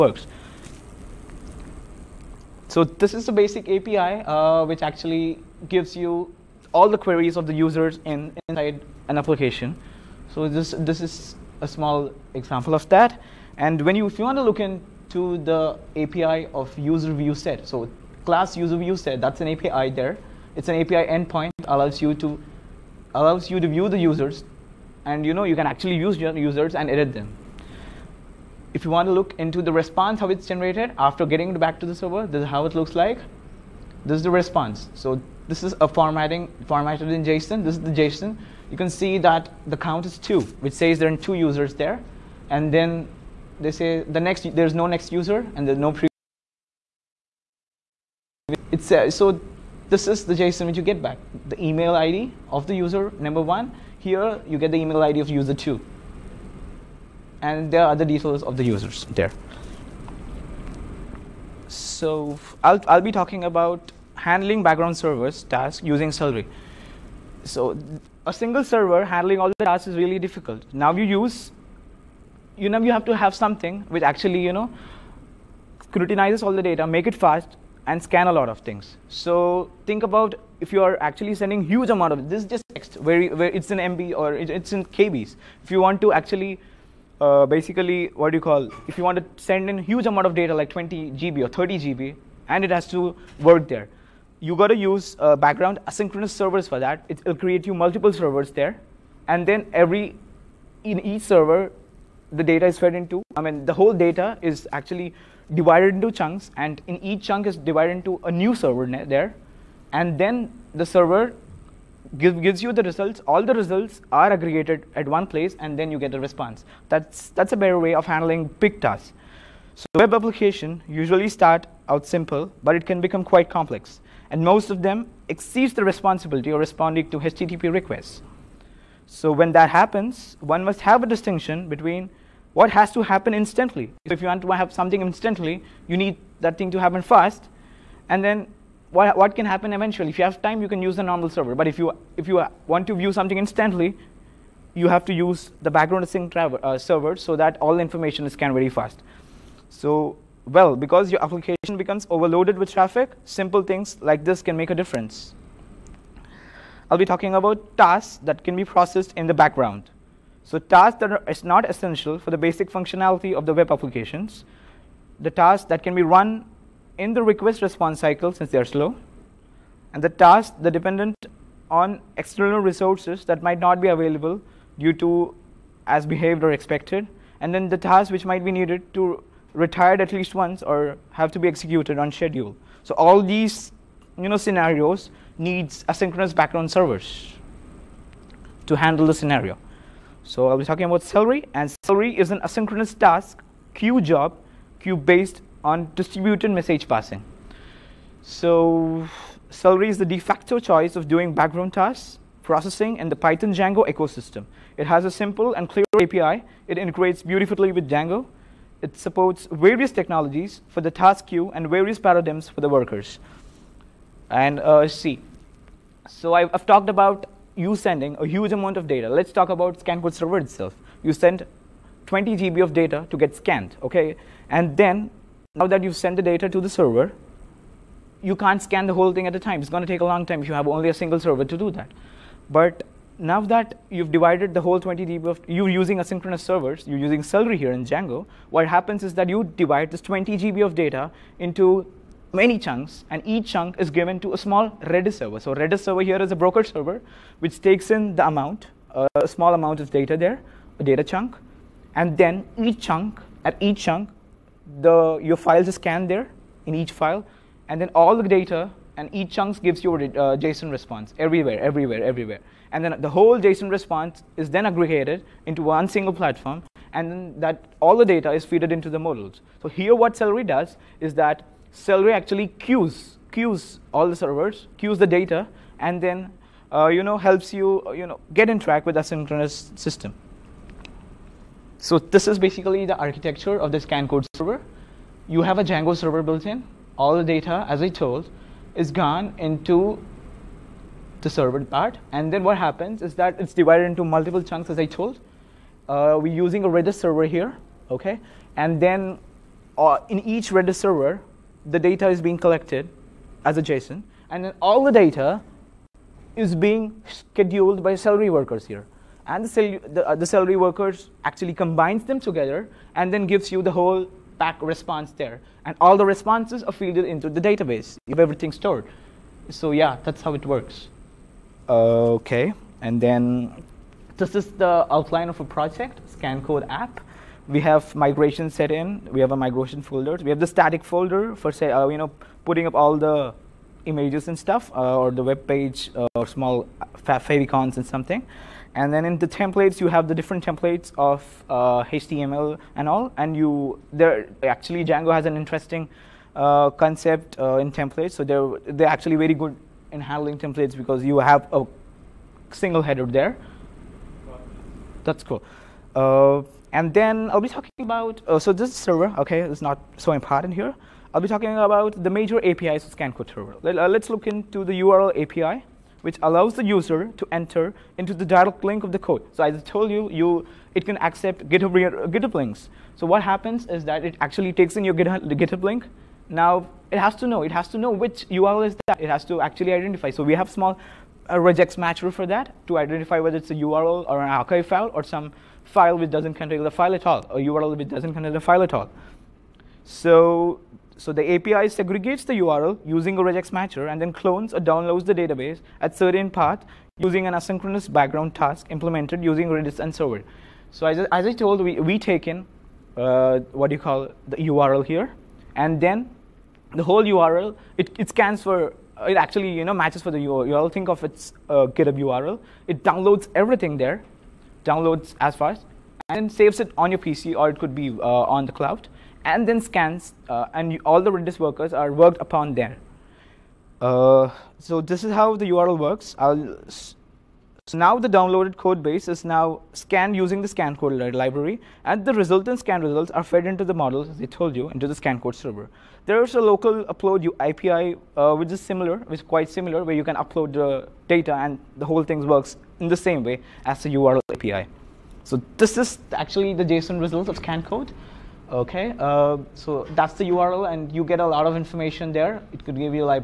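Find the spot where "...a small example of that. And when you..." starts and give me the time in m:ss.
0:11.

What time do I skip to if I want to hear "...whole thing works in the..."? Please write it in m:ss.
7:21.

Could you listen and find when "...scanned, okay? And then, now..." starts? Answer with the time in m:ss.
3:43.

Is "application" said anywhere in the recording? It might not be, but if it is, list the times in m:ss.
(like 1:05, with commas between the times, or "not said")
0:09, 2:00, 2:31, 2:43.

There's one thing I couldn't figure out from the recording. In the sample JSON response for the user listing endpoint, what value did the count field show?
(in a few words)
2.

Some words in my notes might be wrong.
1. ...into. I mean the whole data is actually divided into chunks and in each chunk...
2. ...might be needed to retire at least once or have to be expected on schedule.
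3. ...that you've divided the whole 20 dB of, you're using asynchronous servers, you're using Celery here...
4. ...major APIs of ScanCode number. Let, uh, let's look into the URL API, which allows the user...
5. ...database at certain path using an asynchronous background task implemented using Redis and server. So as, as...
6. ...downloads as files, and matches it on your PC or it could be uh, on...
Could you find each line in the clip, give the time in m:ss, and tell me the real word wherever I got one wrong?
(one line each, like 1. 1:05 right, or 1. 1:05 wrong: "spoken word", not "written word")
1. 1:42 right
2. 2:58 wrong: "executed", not "expected"
3. 3:53 right
4. 6:02 wrong: "server", not "number"
5. 6:35 right
6. 6:54 wrong: "saves", not "matches".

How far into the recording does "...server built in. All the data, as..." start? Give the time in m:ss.
4:45.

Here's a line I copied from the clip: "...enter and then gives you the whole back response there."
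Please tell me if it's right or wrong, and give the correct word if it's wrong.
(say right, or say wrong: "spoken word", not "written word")
wrong: "together", not "enter".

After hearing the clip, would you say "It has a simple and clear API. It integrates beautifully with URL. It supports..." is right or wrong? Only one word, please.
wrong.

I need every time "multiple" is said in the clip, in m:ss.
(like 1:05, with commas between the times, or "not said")
1:37, 4:54.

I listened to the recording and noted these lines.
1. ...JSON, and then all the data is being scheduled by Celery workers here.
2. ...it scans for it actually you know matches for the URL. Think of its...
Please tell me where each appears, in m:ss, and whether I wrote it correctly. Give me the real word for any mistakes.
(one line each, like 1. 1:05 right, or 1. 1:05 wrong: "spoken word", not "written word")
1. 5:03 right
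2. 6:47 right.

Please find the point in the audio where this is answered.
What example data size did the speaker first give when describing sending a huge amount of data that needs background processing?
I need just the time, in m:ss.
1:30.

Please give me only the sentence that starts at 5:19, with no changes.
So yeah, that's how it works.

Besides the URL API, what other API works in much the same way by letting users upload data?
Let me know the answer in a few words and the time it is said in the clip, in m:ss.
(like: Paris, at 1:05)
local upload API, at 7:16.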